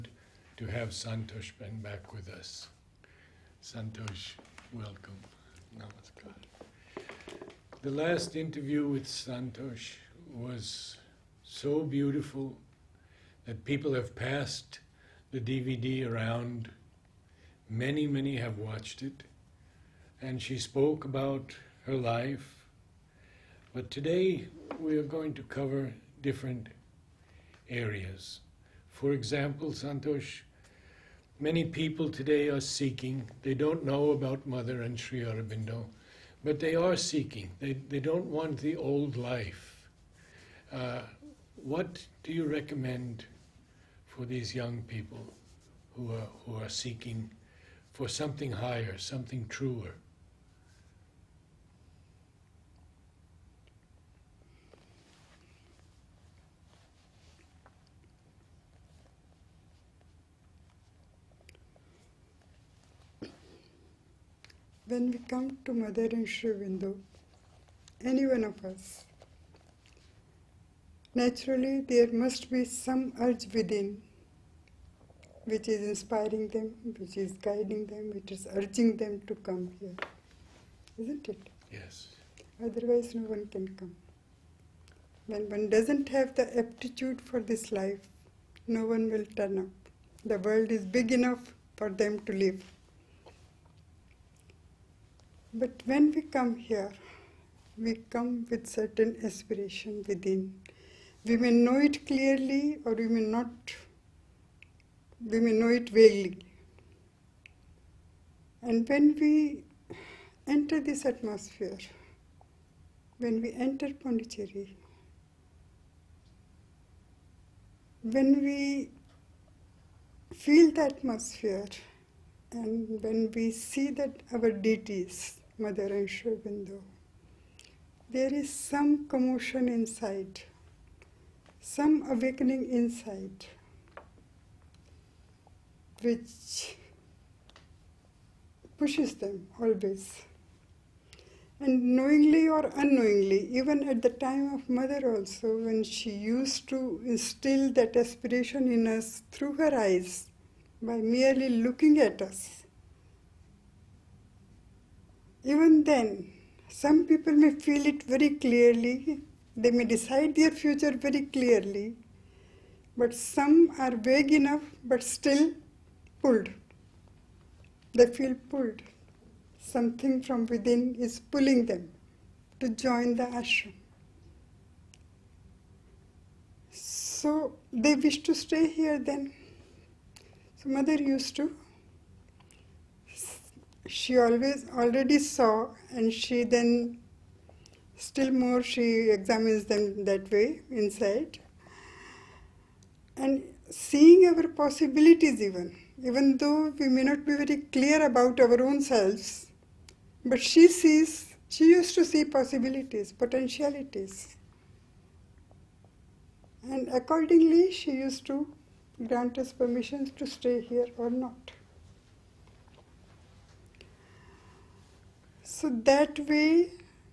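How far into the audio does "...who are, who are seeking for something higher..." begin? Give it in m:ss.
0:45.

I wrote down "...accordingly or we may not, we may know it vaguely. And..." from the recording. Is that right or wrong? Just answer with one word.
wrong.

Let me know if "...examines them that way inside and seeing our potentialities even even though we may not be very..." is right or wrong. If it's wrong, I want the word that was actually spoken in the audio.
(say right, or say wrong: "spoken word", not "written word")
wrong: "possibilities", not "potentialities".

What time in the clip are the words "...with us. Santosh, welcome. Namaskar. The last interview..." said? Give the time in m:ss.
0:02.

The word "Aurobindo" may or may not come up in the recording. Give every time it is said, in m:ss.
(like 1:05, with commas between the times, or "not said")
0:35, 1:06, 2:06.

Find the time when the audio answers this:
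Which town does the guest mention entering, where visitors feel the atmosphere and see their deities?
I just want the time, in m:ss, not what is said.
1:53.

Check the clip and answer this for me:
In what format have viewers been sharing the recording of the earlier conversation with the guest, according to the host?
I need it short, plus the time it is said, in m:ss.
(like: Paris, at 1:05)
DVD, at 0:15.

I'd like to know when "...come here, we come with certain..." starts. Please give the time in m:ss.
1:36.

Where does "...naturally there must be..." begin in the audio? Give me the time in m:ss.
1:11.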